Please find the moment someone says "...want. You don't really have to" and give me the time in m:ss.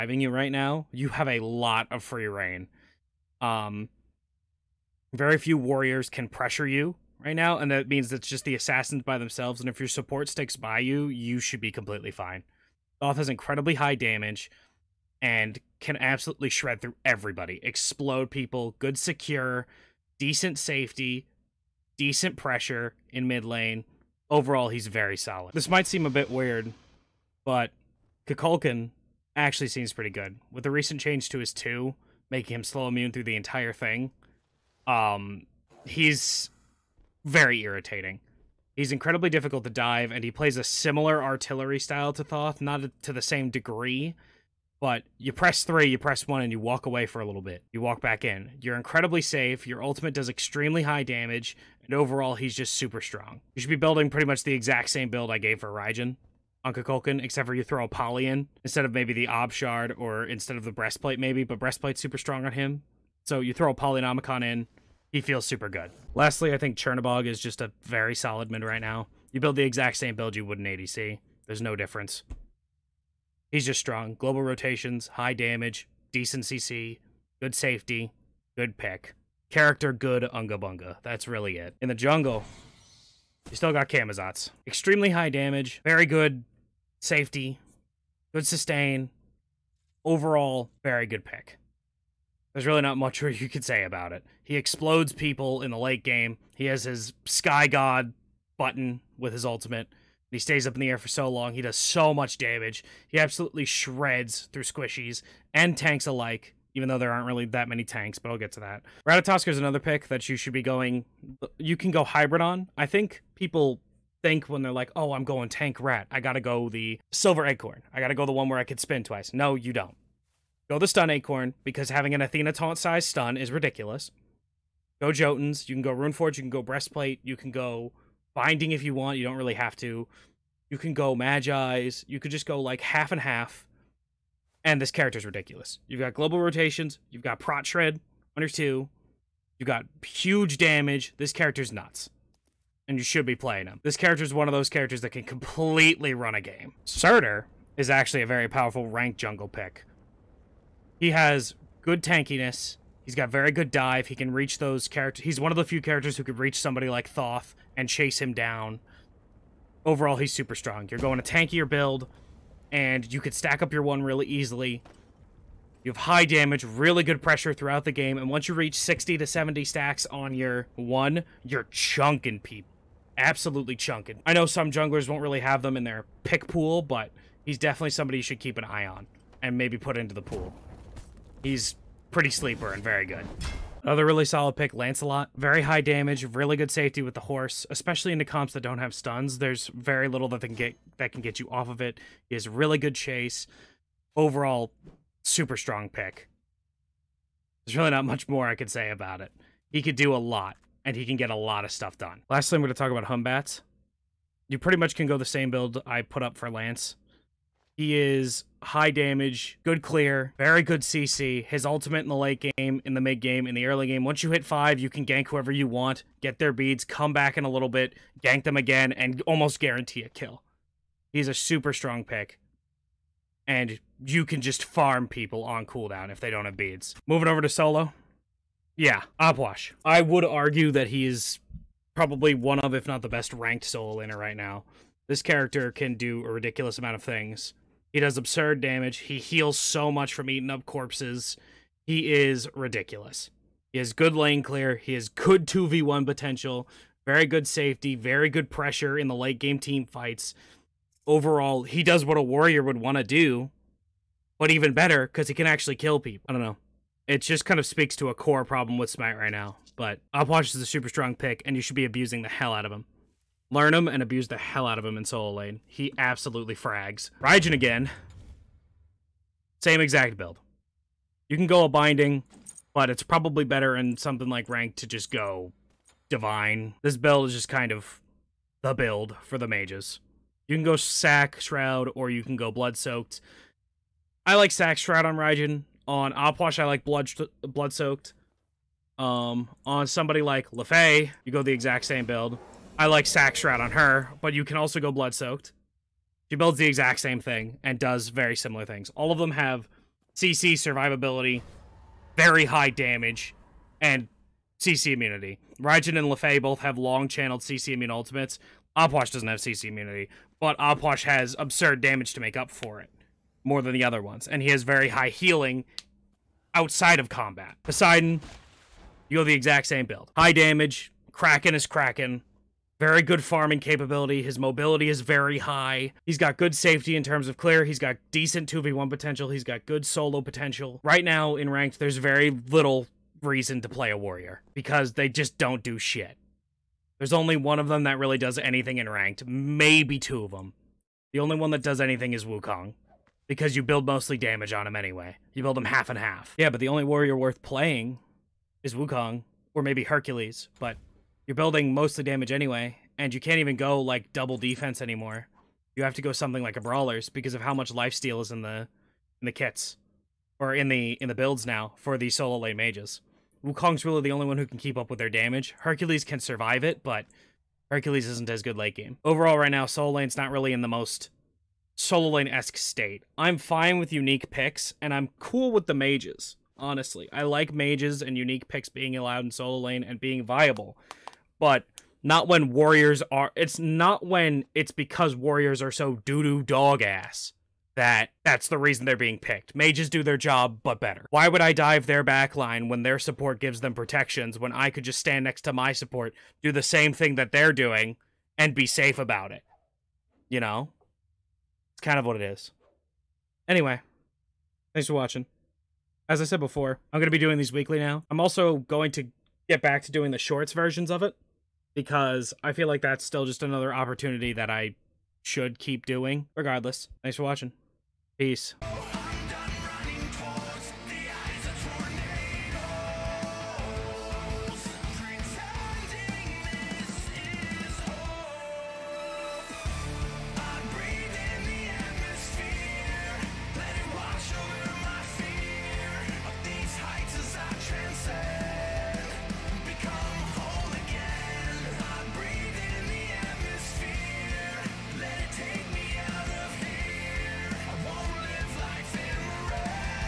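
2:08.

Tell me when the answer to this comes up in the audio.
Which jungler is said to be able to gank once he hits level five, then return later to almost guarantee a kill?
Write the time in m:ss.
3:23.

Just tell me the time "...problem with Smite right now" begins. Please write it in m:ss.
4:18.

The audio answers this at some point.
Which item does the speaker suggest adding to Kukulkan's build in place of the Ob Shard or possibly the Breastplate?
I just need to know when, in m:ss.
1:03.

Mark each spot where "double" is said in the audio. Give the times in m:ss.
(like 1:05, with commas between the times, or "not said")
5:54.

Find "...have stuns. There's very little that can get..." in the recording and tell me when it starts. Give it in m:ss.
3:08.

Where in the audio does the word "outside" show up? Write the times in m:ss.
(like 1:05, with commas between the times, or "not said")
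5:16.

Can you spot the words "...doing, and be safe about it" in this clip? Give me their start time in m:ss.
6:37.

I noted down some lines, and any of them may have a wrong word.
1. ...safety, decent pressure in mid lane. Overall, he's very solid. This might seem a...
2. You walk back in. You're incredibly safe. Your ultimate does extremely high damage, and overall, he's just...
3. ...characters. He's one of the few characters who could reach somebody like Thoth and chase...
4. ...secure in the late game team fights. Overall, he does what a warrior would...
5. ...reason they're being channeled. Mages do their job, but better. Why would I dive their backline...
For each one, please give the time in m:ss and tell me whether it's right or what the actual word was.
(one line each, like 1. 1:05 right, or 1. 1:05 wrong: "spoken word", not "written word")
1. 0:20 right
2. 0:47 right
3. 2:34 right
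4. 4:08 wrong: "pressure", not "secure"
5. 6:28 wrong: "picked", not "channeled".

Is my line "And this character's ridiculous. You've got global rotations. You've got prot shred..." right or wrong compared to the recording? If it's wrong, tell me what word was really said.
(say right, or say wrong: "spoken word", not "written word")
right.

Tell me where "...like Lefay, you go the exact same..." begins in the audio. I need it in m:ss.
4:50.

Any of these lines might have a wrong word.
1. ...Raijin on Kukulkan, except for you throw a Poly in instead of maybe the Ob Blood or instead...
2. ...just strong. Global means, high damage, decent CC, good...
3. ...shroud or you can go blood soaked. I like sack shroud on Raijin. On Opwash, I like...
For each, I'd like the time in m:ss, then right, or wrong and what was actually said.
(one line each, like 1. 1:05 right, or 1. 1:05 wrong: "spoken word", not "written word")
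1. 0:55 wrong: "Shard", not "Blood"
2. 1:13 wrong: "rotations", not "means"
3. 4:41 right.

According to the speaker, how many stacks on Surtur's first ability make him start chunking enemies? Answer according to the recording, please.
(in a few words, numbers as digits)
60 to 70.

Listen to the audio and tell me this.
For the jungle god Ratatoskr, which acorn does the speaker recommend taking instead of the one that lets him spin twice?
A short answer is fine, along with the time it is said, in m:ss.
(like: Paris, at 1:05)
stun acorn, at 2:00.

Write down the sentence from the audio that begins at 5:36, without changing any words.
There's only one of them that really does anything in ranked, maybe two of them.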